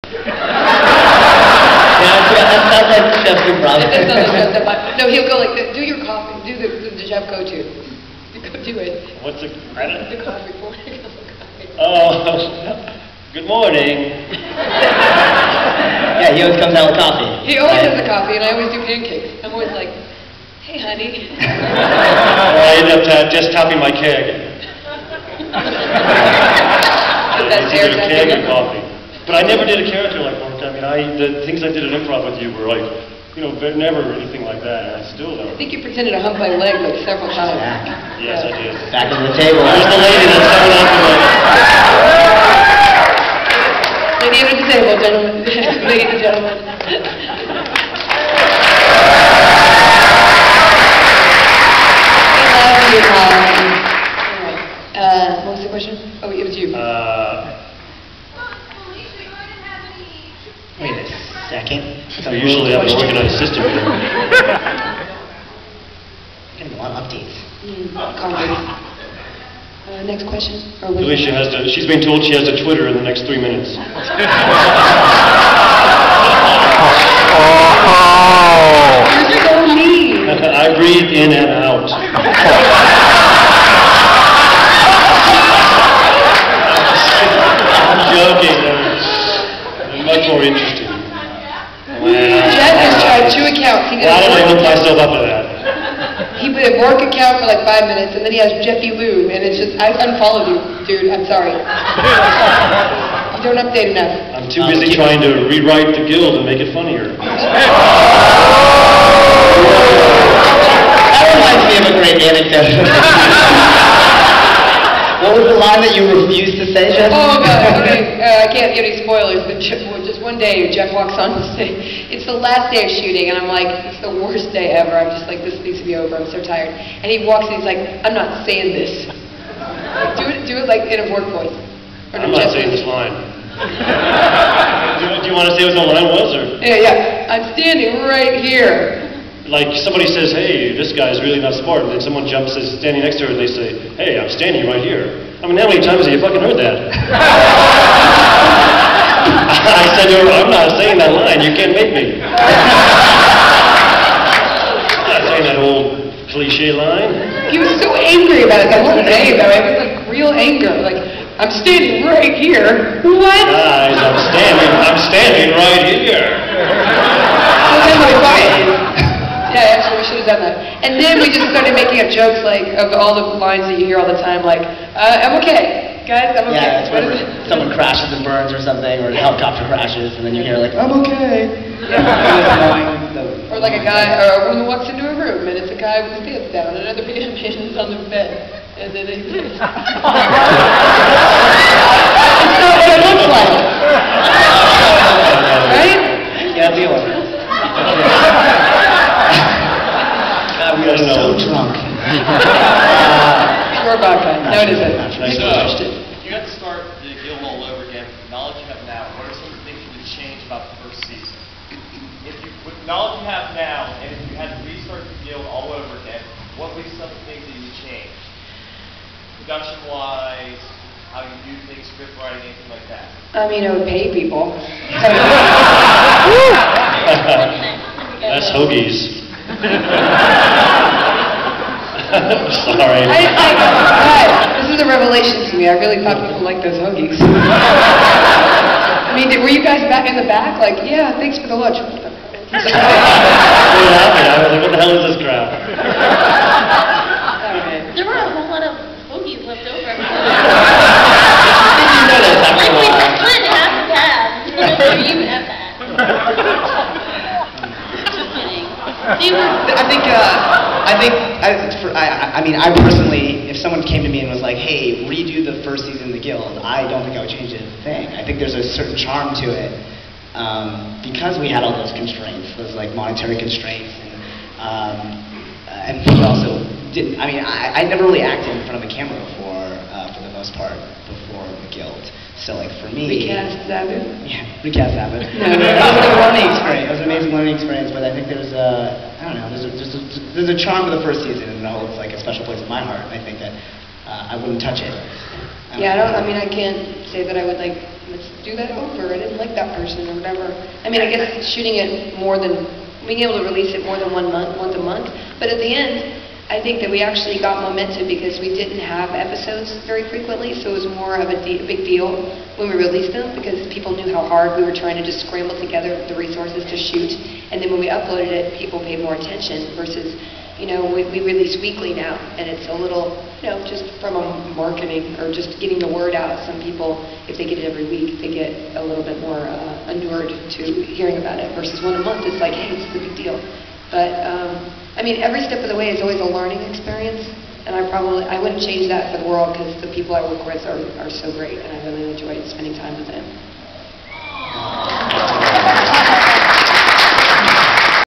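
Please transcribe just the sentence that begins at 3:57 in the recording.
I mean, were you guys back in the back?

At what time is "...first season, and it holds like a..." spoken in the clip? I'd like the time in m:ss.
4:51.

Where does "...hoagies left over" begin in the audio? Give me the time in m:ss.
4:09.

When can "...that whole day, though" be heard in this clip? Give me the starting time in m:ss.
2:38.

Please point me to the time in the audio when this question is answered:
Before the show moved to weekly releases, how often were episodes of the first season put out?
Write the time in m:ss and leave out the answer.
5:04.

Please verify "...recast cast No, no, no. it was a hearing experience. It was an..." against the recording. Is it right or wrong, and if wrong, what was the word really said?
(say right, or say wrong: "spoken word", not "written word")
wrong: "learning", not "hearing".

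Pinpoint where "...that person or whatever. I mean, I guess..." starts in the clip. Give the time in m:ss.
4:59.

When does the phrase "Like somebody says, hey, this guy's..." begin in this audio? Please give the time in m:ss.
2:19.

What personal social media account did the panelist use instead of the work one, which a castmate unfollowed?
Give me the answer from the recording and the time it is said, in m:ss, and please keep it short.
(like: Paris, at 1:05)
Jeffy Lou, at 1:38.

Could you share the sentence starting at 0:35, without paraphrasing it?
I think you pretended to hump my leg like several times.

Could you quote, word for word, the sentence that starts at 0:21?
well, I end up uh, just topping my keg.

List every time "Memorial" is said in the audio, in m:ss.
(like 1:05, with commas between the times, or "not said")
not said.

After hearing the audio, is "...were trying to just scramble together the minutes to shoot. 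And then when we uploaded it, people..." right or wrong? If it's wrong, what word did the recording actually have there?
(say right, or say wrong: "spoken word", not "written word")
wrong: "resources", not "minutes".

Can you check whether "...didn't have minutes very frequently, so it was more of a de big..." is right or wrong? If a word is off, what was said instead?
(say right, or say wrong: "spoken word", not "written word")
wrong: "episodes", not "minutes".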